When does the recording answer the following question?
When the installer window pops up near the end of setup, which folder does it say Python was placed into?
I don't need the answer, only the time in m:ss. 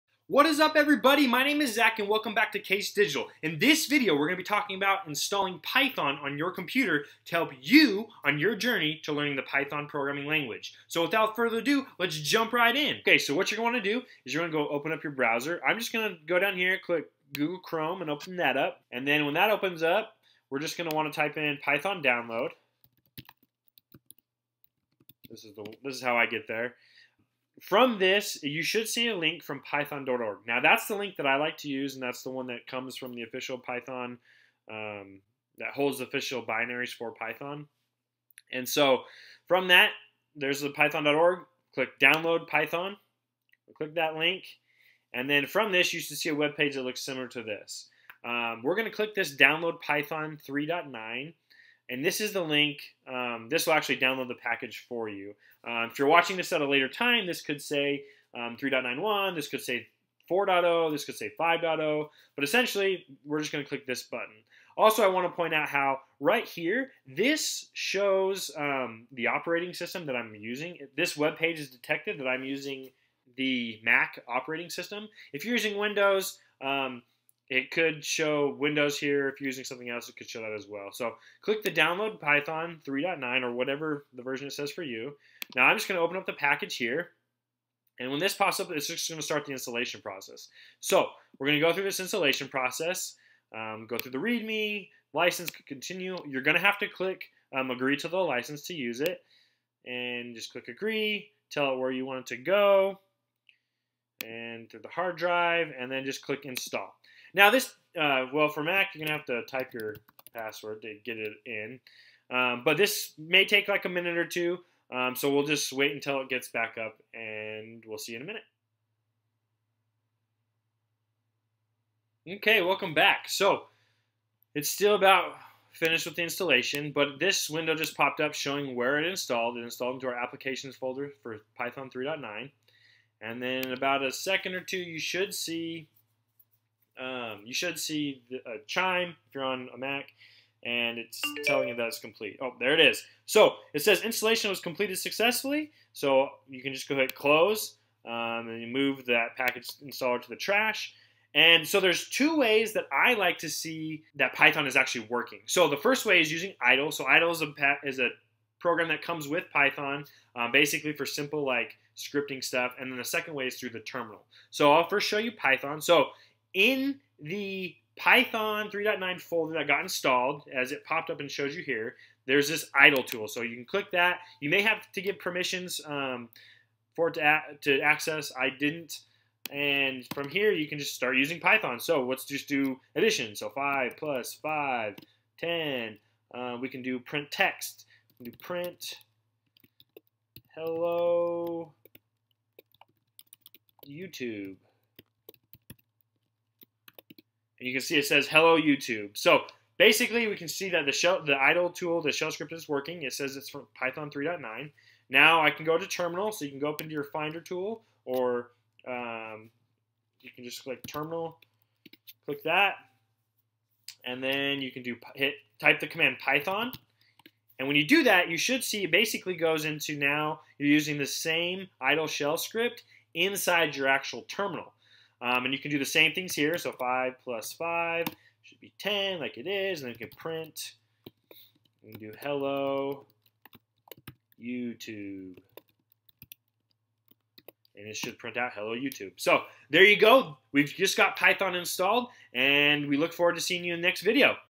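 2:10.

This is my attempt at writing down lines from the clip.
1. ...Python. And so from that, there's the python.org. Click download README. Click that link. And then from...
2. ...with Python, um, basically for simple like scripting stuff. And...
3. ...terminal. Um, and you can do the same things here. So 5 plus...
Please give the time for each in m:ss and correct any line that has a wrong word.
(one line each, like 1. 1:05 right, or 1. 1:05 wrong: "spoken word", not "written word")
1. 0:37 wrong: "Python", not "README"
2. 2:39 right
3. 3:44 right.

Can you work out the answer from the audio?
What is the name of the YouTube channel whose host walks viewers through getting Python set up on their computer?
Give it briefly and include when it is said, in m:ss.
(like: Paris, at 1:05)
Case Digital, at 0:02.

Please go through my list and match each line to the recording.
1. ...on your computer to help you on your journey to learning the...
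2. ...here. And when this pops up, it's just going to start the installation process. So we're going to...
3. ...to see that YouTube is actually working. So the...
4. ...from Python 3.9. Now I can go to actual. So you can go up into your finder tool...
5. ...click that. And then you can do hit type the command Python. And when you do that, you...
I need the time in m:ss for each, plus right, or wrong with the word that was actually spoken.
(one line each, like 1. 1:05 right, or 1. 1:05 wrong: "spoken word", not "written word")
1. 0:06 right
2. 1:26 right
3. 2:33 wrong: "Python", not "YouTube"
4. 3:23 wrong: "terminal", not "actual"
5. 3:32 right.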